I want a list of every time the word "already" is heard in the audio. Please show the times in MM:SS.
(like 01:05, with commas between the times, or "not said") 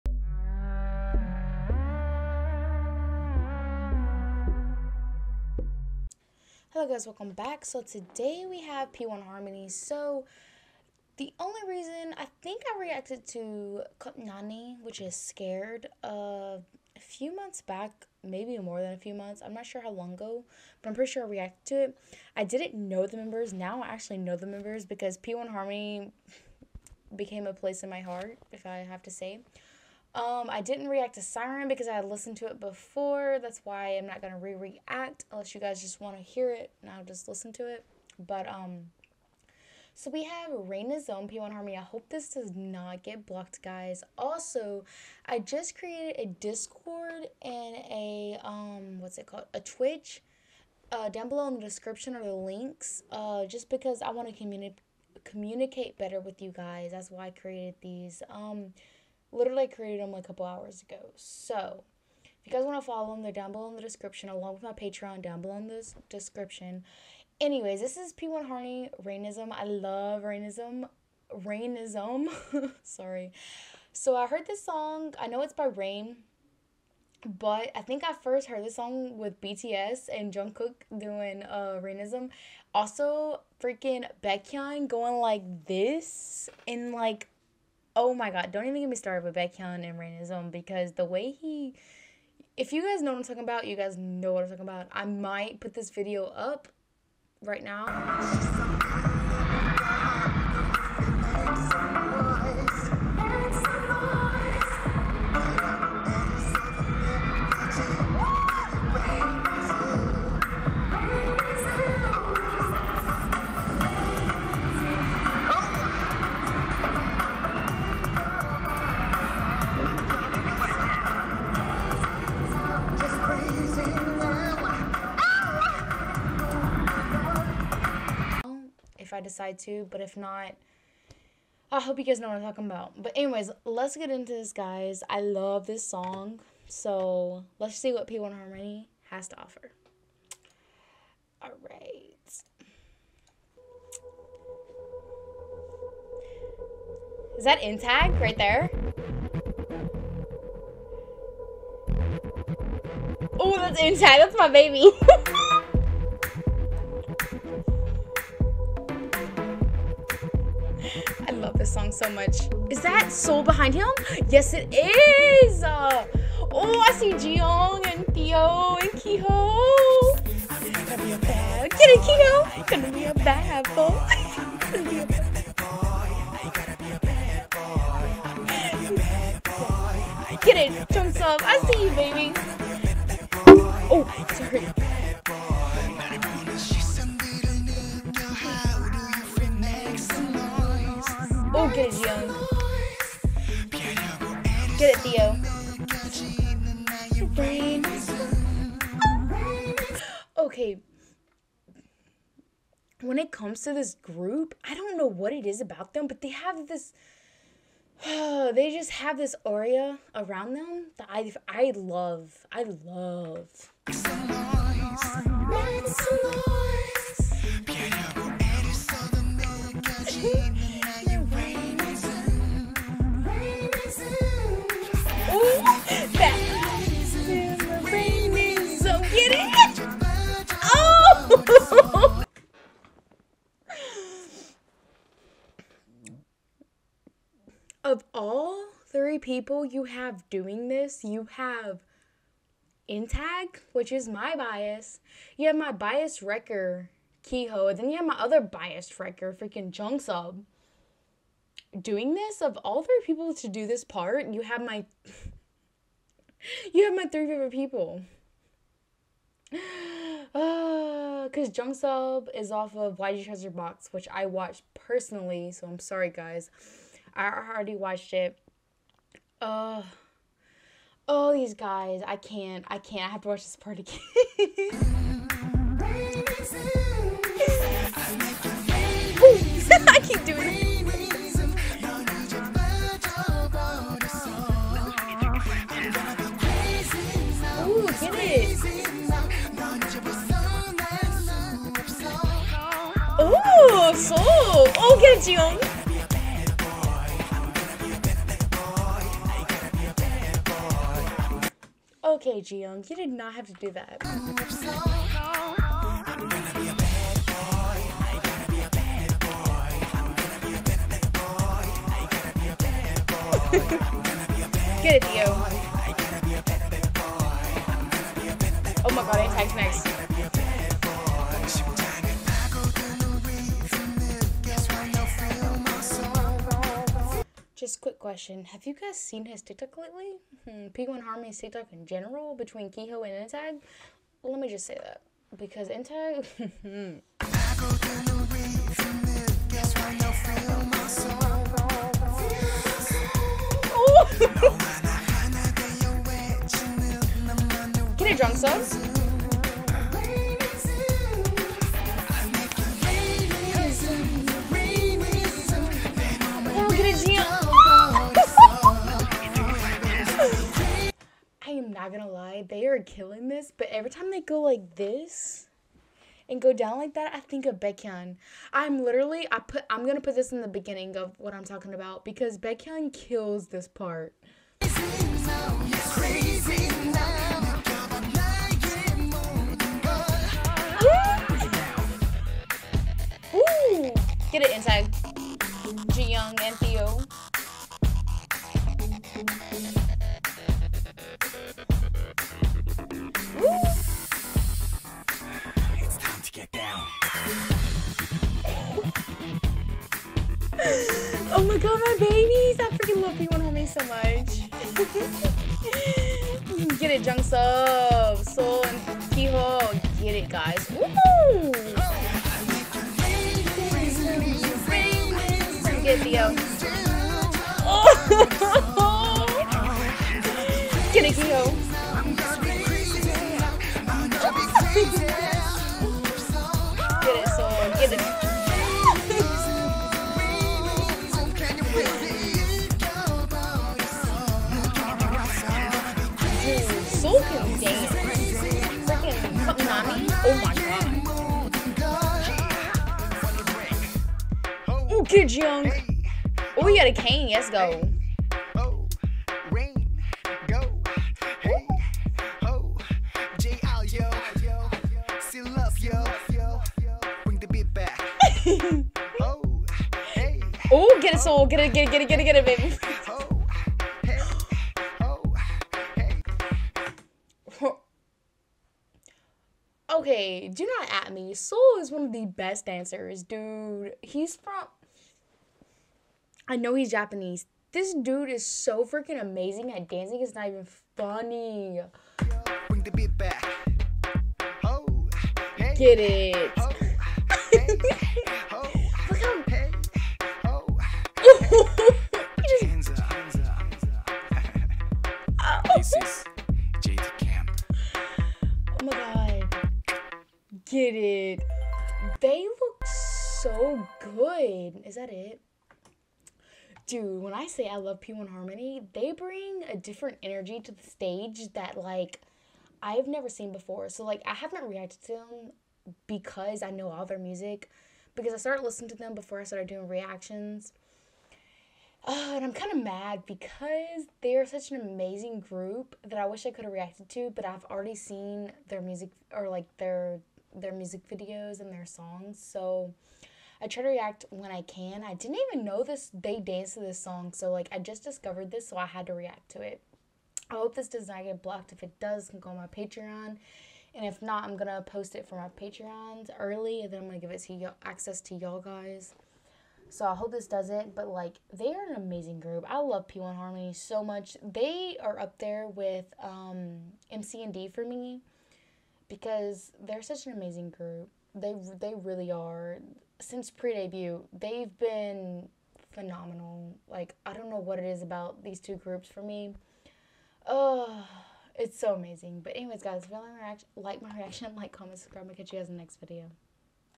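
04:27, 08:47.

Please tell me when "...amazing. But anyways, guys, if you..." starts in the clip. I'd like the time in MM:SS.
09:31.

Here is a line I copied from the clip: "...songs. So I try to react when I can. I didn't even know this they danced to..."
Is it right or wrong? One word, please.
right.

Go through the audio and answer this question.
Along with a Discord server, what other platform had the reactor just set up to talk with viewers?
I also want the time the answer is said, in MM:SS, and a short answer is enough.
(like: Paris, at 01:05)
Twitch, at 00:49.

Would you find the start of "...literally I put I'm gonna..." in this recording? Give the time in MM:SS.
06:08.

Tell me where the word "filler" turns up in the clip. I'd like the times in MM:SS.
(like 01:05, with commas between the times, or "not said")
not said.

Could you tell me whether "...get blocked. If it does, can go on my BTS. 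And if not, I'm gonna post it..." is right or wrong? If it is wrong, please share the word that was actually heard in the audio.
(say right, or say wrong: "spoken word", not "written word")
wrong: "Patreon", not "BTS".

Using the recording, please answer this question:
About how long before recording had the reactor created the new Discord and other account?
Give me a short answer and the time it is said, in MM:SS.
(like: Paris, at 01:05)
A couple hours, at 01:00.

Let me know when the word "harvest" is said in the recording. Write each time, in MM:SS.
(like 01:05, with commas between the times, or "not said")
not said.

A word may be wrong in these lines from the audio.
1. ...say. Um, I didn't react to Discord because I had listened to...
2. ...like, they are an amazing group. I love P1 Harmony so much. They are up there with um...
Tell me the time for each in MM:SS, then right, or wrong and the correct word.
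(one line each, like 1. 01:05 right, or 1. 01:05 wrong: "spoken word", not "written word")
1. 00:29 wrong: "Siren", not "Discord"
2. 09:11 right.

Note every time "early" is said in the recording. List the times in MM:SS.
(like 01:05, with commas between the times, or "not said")
09:06.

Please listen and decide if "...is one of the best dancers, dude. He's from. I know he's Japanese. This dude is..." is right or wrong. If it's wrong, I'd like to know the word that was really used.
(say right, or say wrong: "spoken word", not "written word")
right.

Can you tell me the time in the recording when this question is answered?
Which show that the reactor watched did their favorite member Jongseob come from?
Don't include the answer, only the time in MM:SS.
04:22.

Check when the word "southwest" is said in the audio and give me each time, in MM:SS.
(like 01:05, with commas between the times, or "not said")
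not said.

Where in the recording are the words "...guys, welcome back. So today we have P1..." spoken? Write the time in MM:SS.
00:06.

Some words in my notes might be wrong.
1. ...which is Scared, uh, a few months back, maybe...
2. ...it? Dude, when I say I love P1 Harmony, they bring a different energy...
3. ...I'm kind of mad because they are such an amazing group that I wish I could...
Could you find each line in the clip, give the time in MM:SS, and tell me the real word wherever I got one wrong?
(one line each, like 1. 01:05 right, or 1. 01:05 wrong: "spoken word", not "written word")
1. 00:14 right
2. 08:25 right
3. 08:42 right.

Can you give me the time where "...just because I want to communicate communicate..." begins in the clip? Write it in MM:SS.
00:53.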